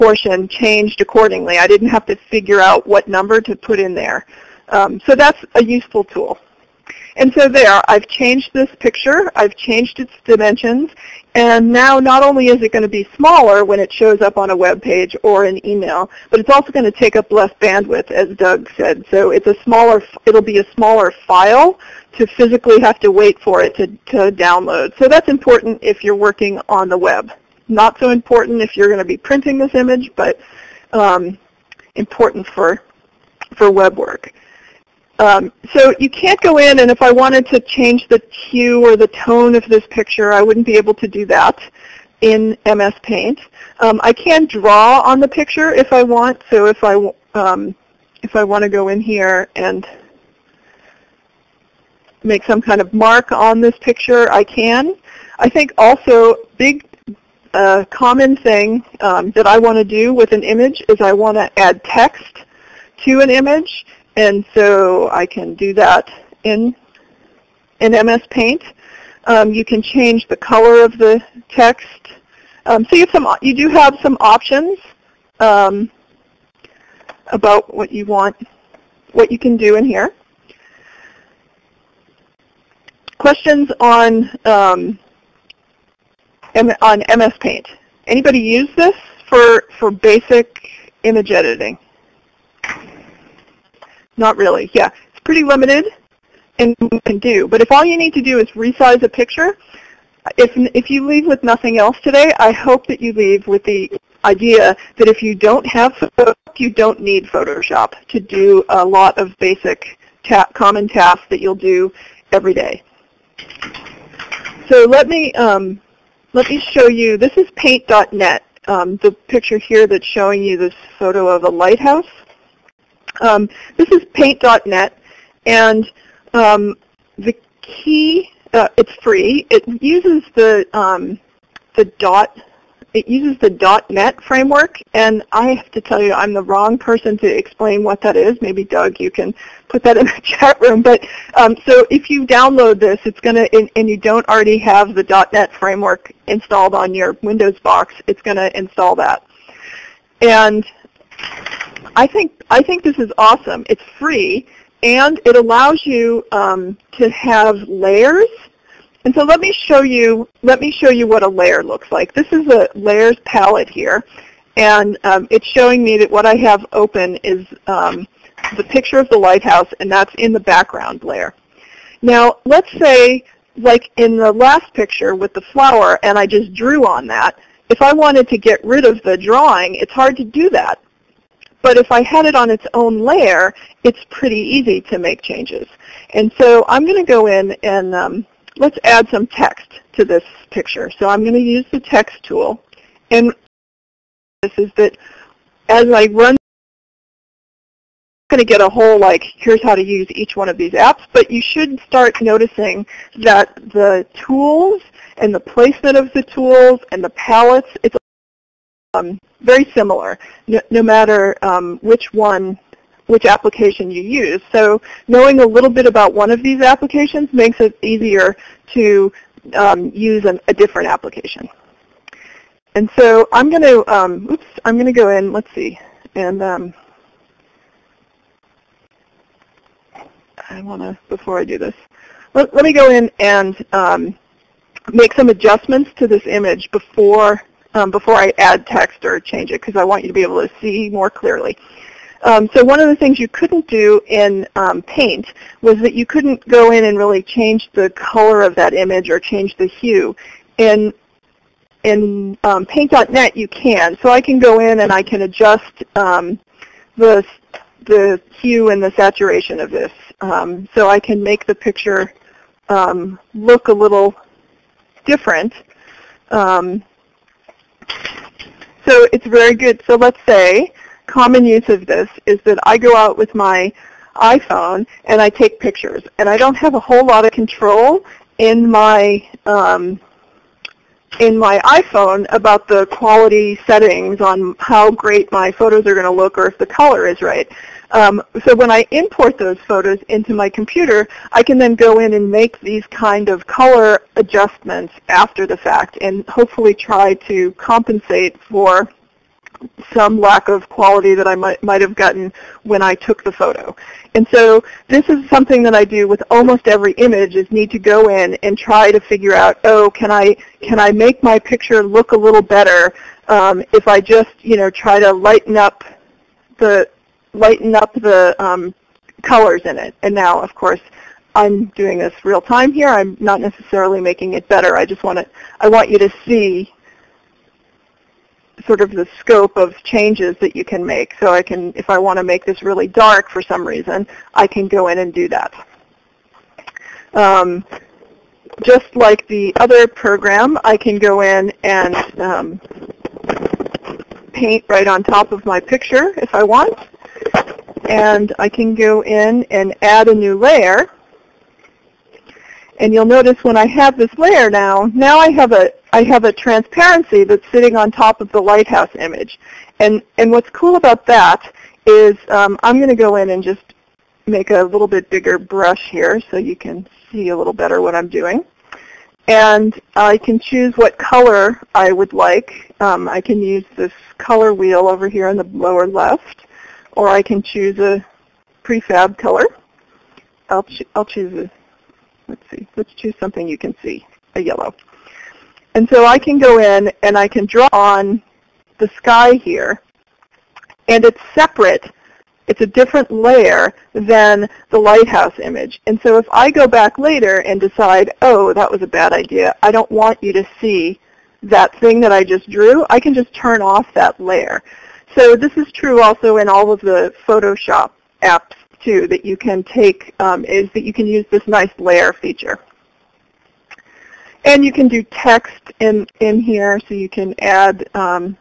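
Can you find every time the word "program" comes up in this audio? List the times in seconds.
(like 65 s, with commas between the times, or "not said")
339 s.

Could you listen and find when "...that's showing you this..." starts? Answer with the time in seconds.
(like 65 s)
119 s.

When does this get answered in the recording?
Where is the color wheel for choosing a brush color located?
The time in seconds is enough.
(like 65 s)
375 s.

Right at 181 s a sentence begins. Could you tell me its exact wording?
But if I had it on its own layer, it's pretty easy to make changes.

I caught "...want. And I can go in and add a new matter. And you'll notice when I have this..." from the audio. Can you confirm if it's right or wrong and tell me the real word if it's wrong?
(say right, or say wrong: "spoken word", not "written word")
wrong: "layer", not "matter".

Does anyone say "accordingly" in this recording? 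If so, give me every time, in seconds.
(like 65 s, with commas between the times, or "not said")
1 s.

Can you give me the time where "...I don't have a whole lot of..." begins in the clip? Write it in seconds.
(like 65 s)
276 s.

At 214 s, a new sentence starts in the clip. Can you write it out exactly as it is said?
So knowing a little bit about one of these applications makes it easier to um, use an, a different application.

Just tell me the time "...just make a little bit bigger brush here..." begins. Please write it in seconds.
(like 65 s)
363 s.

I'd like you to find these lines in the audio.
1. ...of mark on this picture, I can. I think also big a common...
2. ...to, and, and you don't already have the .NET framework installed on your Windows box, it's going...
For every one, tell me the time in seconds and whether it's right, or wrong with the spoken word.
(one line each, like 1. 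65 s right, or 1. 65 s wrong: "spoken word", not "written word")
1. 52 s right
2. 143 s right.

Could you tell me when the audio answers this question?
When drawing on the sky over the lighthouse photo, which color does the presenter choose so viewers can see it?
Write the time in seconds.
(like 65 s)
384 s.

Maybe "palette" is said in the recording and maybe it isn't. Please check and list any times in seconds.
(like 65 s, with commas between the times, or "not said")
163 s, 207 s.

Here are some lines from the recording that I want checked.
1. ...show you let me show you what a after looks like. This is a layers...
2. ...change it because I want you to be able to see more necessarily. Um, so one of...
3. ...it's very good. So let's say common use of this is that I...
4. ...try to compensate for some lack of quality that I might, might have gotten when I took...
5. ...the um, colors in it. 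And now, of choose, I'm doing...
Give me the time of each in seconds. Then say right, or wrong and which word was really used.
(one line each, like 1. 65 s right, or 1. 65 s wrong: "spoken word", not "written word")
1. 159 s wrong: "layer", not "after"
2. 239 s wrong: "clearly", not "necessarily"
3. 269 s right
4. 296 s right
5. 317 s wrong: "course", not "choose".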